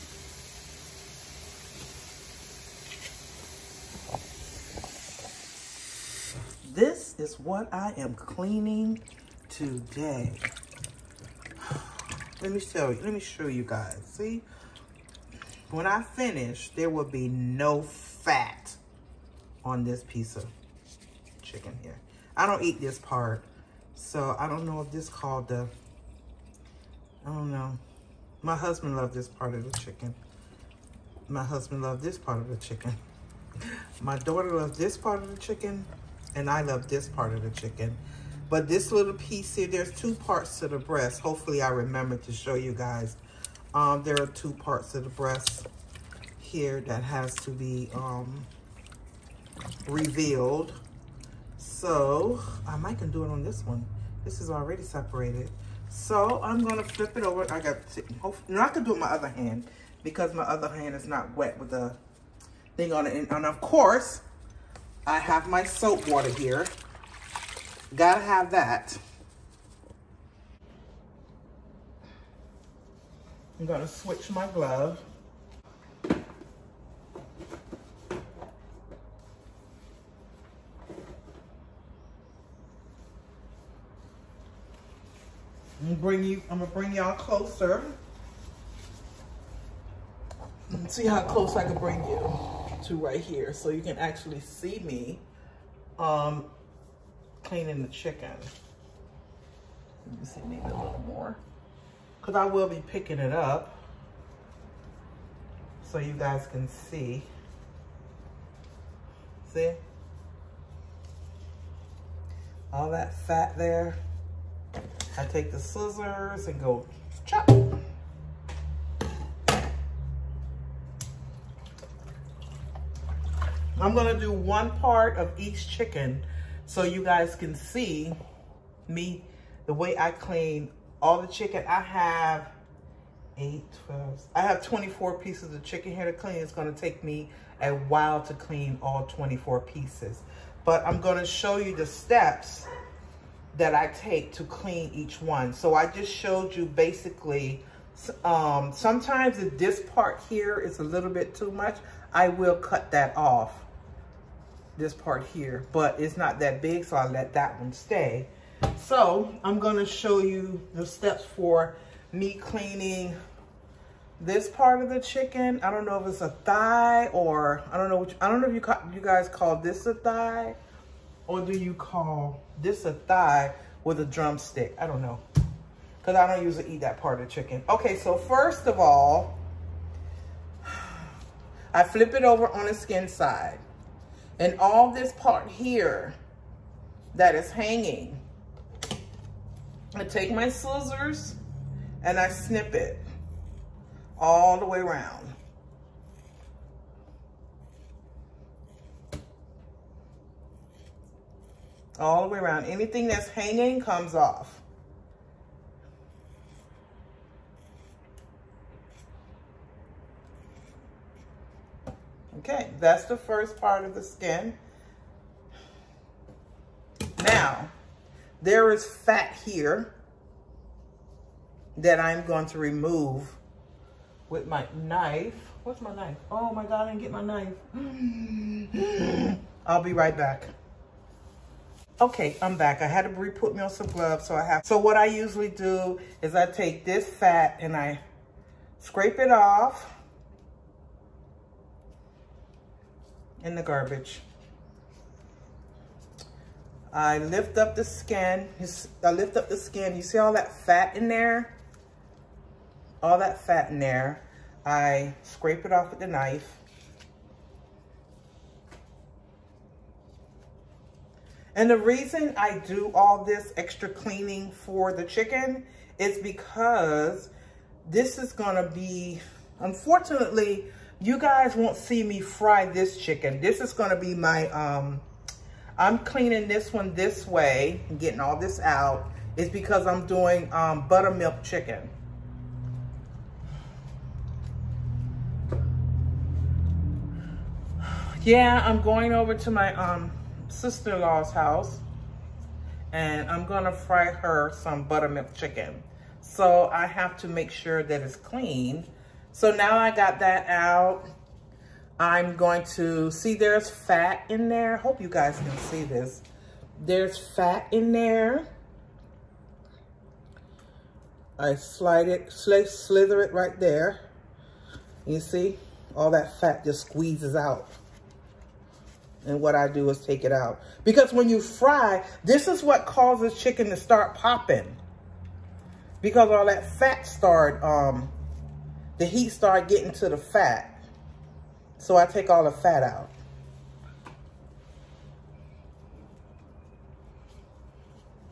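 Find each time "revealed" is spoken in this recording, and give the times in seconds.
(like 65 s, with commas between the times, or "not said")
49 s.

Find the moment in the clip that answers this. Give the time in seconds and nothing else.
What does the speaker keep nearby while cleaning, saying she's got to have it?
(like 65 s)
65 s.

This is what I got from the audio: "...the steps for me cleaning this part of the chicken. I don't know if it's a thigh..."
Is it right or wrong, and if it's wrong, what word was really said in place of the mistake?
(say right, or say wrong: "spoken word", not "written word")
right.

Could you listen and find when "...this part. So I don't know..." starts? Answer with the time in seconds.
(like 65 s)
22 s.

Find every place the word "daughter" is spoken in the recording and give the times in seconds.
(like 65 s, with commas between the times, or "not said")
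34 s.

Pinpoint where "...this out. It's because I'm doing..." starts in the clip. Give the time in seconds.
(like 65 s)
278 s.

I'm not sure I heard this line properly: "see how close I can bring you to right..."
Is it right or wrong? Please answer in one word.
right.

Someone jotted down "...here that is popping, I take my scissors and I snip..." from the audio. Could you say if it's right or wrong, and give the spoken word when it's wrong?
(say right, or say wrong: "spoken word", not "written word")
wrong: "hanging", not "popping".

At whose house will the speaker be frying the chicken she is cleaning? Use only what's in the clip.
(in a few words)
Sister-in-law's.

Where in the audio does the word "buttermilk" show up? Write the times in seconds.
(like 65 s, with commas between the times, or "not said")
280 s, 294 s.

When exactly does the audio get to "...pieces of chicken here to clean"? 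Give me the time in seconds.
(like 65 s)
135 s.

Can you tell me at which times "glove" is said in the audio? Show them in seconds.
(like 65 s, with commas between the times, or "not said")
74 s, 233 s.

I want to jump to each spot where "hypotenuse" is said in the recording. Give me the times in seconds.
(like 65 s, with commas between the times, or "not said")
not said.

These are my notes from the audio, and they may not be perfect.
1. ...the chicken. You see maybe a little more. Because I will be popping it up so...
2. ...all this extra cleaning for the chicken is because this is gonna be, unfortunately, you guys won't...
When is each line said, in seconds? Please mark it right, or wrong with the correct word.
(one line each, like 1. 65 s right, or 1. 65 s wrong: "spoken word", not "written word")
1. 97 s wrong: "picking", not "popping"
2. 262 s right.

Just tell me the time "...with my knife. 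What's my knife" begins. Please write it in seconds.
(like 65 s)
224 s.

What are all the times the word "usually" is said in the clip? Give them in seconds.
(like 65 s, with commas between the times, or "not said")
176 s, 235 s.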